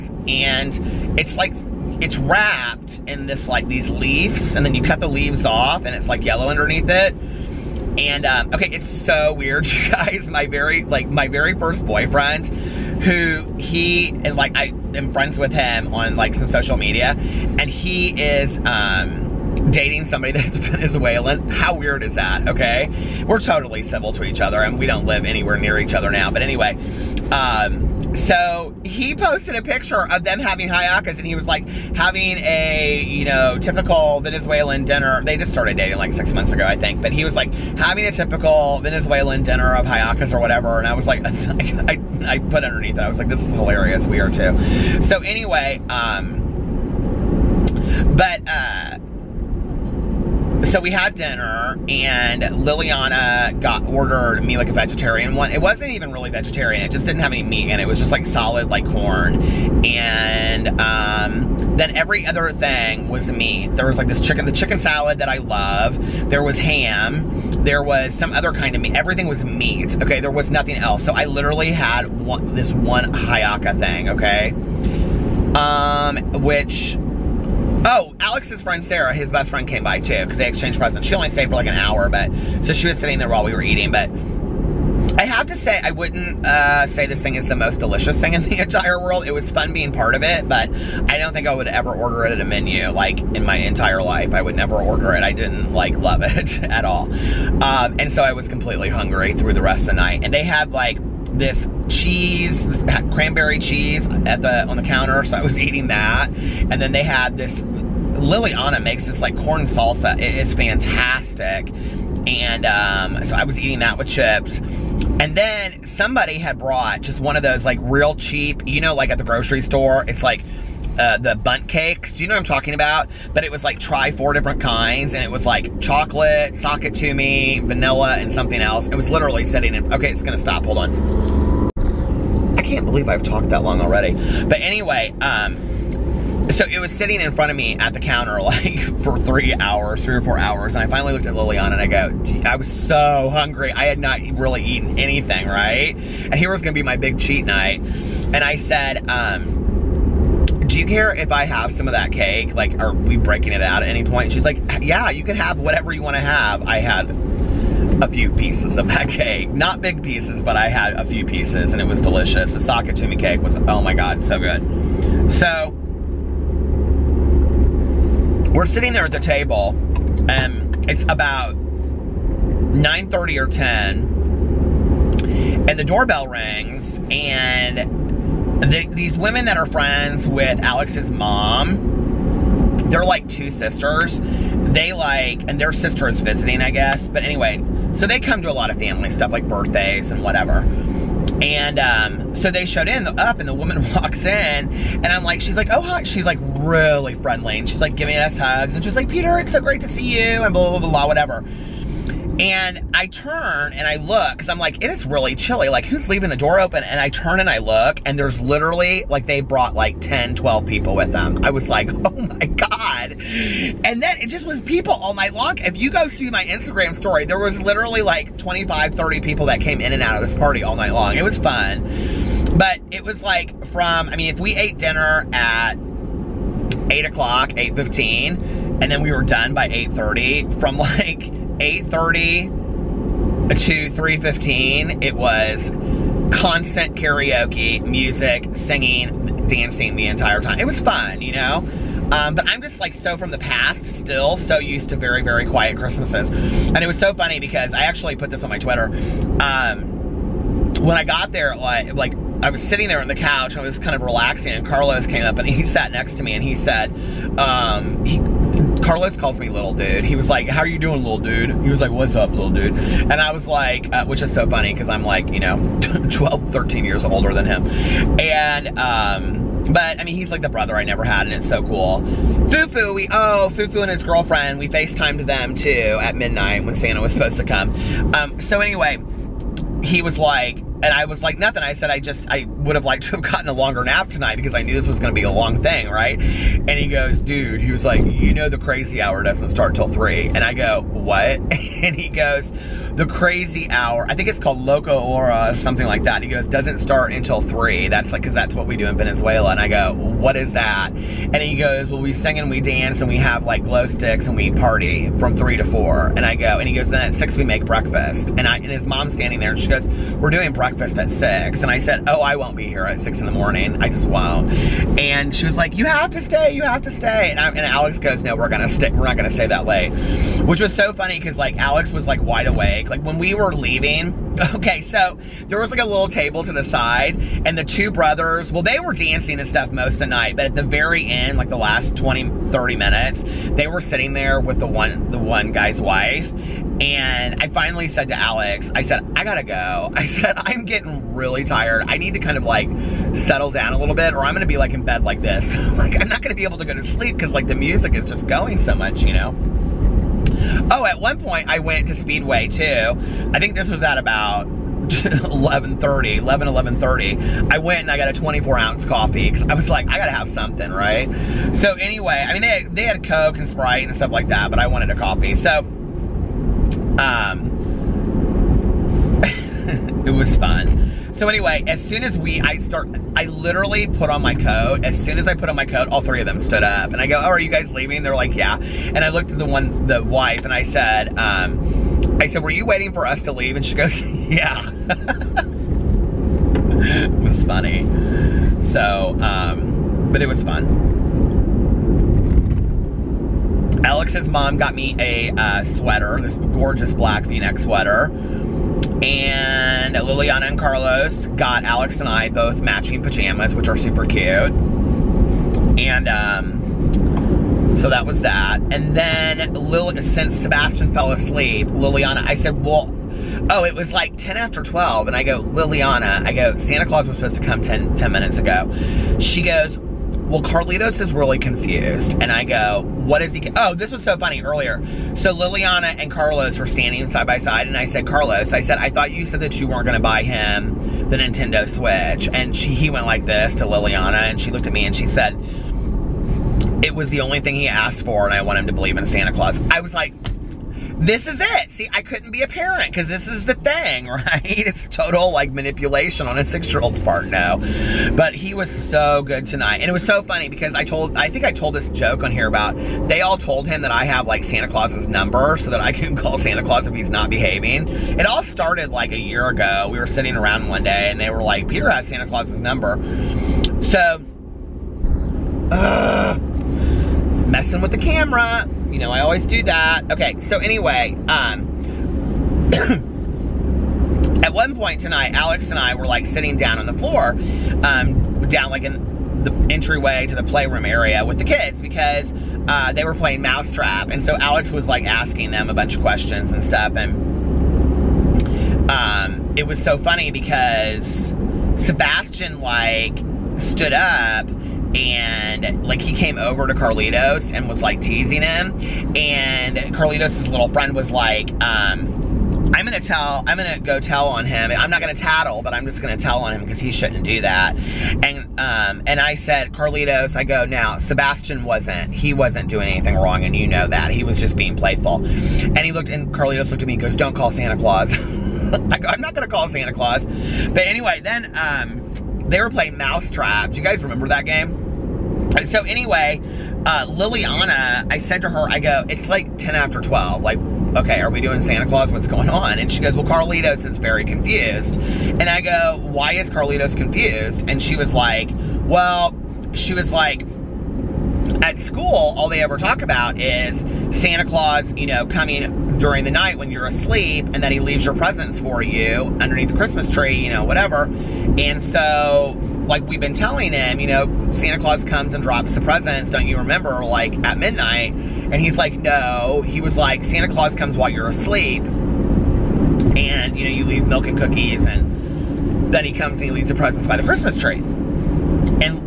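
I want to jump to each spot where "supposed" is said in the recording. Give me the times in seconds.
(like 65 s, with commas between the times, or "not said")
277 s, 417 s.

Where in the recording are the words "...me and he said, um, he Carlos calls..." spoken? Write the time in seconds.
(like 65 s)
256 s.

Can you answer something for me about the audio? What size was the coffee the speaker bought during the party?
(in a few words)
24 ounce.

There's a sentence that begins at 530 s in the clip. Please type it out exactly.
Like, okay, are we doing Santa Claus?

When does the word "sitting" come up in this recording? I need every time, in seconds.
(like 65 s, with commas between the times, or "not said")
82 s, 129 s, 136 s, 168 s, 252 s, 333 s, 460 s, 476 s.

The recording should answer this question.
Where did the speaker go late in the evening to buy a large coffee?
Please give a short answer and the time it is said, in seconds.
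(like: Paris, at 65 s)
Speedway, at 351 s.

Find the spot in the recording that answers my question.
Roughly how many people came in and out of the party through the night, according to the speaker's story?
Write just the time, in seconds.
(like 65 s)
218 s.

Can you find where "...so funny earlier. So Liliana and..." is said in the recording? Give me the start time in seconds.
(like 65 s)
424 s.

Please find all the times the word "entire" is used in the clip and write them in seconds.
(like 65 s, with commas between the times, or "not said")
88 s, 93 s, 240 s.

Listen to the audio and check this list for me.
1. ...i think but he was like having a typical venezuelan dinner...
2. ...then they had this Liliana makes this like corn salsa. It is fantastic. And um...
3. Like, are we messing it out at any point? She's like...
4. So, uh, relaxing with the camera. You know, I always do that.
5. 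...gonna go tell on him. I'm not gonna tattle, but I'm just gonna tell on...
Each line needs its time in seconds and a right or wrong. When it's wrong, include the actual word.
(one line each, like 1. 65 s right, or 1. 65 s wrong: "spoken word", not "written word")
1. 36 s right
2. 106 s right
3. 152 s wrong: "breaking", not "messing"
4. 463 s wrong: "messing", not "relaxing"
5. 503 s right.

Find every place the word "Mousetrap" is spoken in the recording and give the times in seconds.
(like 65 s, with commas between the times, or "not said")
483 s, 522 s.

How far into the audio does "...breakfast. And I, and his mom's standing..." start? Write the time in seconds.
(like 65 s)
307 s.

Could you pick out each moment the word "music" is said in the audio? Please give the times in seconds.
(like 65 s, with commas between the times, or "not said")
237 s, 347 s.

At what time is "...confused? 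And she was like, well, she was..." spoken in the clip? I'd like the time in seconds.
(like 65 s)
536 s.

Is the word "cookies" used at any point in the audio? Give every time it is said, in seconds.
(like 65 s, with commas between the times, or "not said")
564 s.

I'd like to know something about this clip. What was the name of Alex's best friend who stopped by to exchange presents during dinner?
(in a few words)
Sarah.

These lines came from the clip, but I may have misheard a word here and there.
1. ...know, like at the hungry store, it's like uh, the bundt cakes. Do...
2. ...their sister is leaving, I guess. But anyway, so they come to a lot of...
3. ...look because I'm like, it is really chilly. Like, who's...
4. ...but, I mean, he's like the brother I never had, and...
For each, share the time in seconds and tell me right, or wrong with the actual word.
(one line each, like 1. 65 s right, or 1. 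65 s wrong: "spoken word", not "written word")
1. 118 s wrong: "grocery", not "hungry"
2. 185 s wrong: "visiting", not "leaving"
3. 203 s right
4. 269 s right.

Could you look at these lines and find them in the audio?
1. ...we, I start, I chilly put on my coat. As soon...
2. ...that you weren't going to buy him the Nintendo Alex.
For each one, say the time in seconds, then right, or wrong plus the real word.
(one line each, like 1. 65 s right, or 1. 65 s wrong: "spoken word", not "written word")
1. 372 s wrong: "literally", not "chilly"
2. 429 s wrong: "Switch", not "Alex".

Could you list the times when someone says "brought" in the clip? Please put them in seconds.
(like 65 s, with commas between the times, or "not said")
116 s, 209 s.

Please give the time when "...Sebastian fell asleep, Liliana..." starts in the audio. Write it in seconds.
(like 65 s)
410 s.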